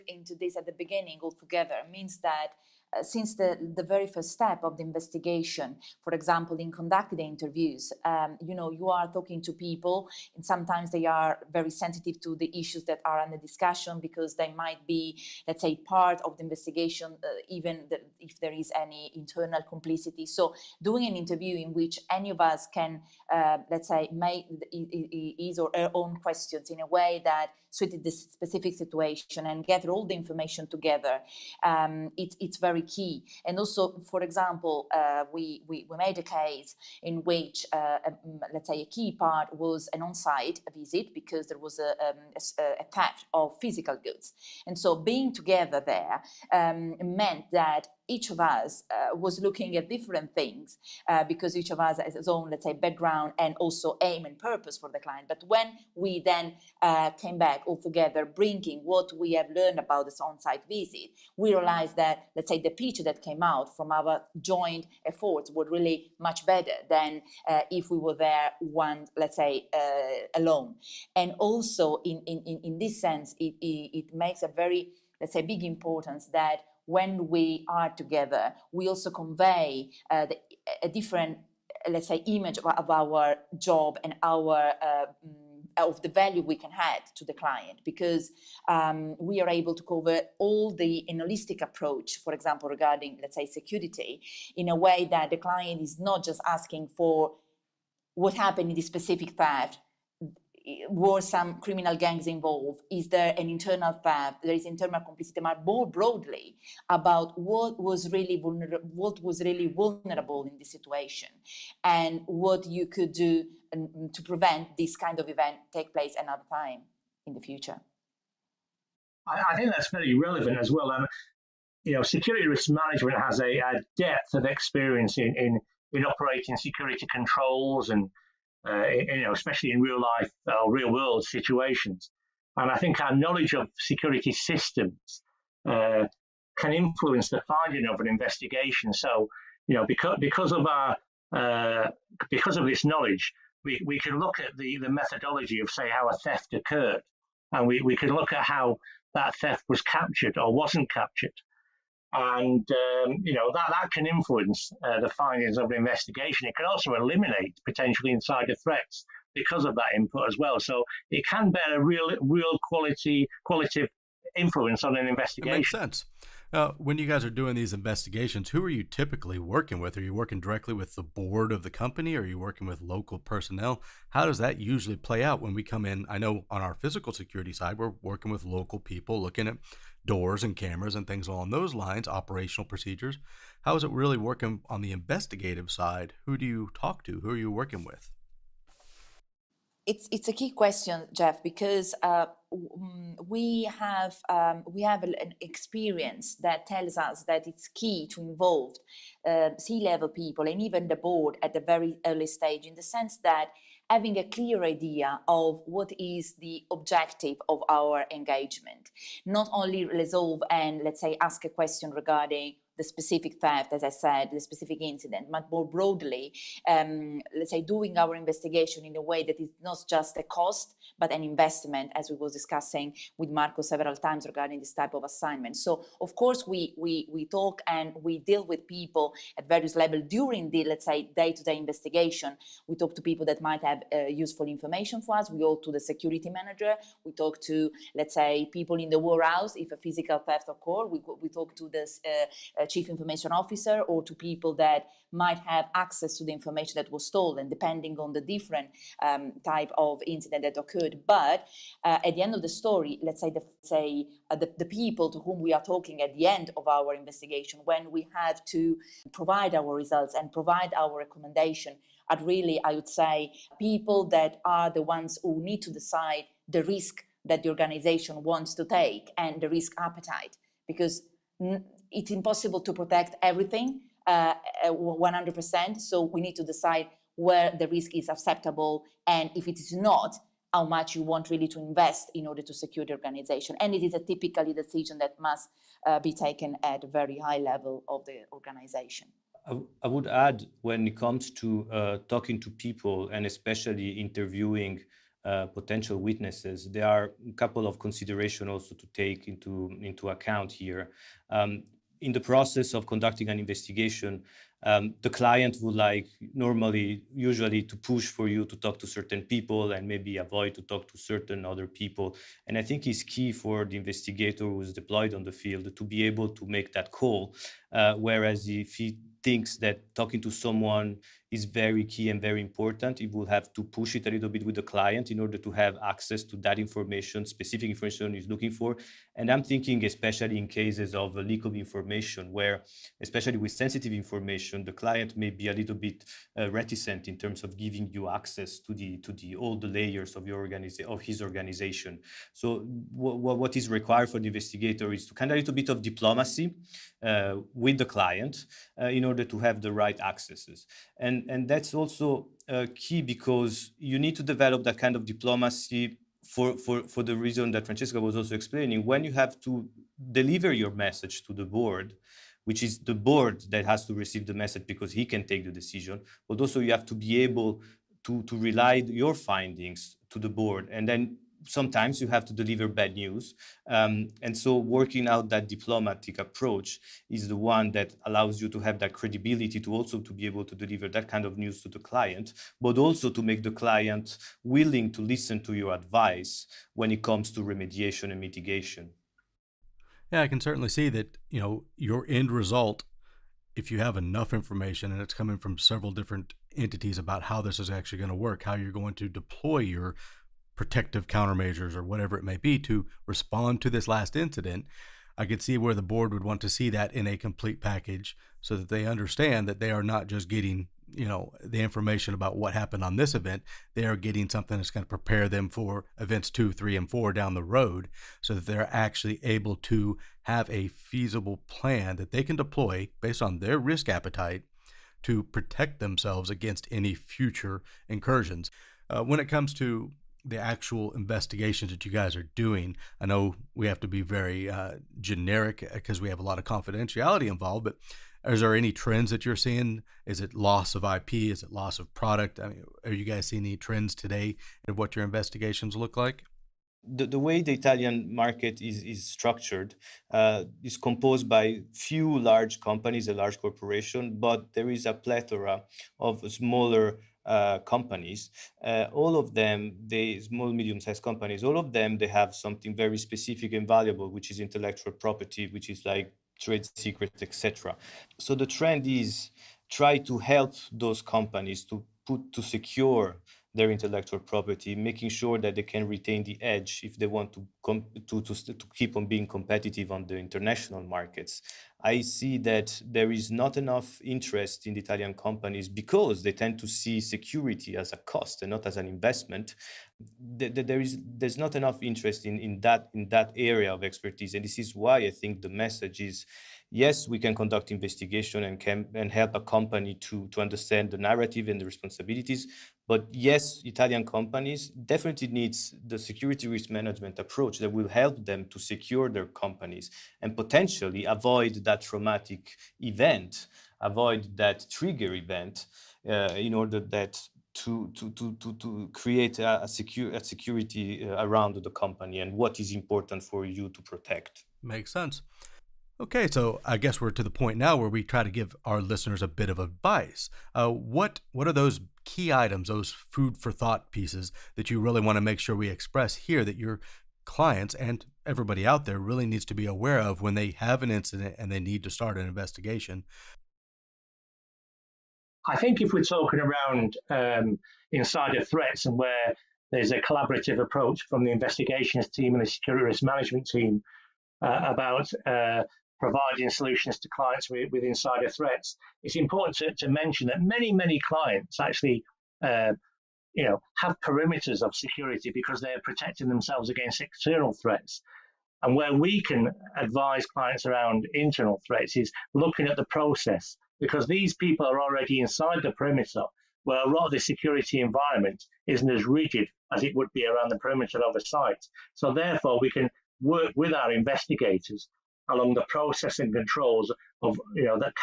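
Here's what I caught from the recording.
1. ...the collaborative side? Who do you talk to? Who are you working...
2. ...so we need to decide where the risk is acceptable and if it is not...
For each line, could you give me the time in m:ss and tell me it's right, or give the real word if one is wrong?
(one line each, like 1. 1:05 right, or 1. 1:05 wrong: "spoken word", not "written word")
1. 3:04 wrong: "investigative", not "collaborative"
2. 4:35 right.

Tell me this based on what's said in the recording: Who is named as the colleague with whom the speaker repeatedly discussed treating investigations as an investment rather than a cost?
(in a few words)
Marco.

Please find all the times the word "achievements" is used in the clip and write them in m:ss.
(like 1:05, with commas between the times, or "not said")
not said.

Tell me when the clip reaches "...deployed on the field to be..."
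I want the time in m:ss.
5:14.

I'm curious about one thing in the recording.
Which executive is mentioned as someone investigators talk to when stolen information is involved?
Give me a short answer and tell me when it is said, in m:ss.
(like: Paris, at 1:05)
Chief information officer, at 4:02.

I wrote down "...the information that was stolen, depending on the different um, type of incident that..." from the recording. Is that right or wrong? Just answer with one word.
right.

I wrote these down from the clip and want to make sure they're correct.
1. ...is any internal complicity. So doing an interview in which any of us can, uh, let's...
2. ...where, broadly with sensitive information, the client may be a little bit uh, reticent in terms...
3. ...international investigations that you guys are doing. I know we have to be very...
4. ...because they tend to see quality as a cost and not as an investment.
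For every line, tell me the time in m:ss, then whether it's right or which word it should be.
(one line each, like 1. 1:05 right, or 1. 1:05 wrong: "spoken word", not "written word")
1. 0:18 right
2. 5:32 wrong: "especially", not "broadly"
3. 7:10 wrong: "actual", not "international"
4. 8:05 wrong: "security", not "quality".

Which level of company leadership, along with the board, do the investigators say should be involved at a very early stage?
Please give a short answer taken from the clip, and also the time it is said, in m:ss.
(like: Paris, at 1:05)
C-level, at 3:19.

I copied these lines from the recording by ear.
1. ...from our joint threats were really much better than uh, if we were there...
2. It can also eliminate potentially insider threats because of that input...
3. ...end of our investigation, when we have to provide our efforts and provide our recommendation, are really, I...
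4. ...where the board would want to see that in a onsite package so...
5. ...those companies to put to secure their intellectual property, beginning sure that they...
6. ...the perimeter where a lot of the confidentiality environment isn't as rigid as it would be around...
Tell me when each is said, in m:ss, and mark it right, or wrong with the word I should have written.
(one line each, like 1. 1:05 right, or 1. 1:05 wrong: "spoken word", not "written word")
1. 1:03 wrong: "efforts", not "threats"
2. 2:36 right
3. 4:16 wrong: "results", not "efforts"
4. 6:45 wrong: "complete", not "onsite"
5. 7:50 wrong: "making", not "beginning"
6. 9:35 wrong: "security", not "confidentiality".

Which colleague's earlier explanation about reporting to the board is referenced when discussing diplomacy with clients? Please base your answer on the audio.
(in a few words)
Francesca.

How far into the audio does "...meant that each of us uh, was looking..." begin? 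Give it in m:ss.
0:47.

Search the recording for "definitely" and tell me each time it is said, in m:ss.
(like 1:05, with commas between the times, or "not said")
8:24.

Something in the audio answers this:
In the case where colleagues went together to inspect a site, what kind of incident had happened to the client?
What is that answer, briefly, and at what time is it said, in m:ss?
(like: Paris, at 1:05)
Theft of physical goods, at 0:42.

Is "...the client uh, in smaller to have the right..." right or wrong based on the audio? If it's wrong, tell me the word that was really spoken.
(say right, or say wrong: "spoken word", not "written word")
wrong: "order", not "smaller".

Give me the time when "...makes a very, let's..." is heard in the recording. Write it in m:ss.
1:14.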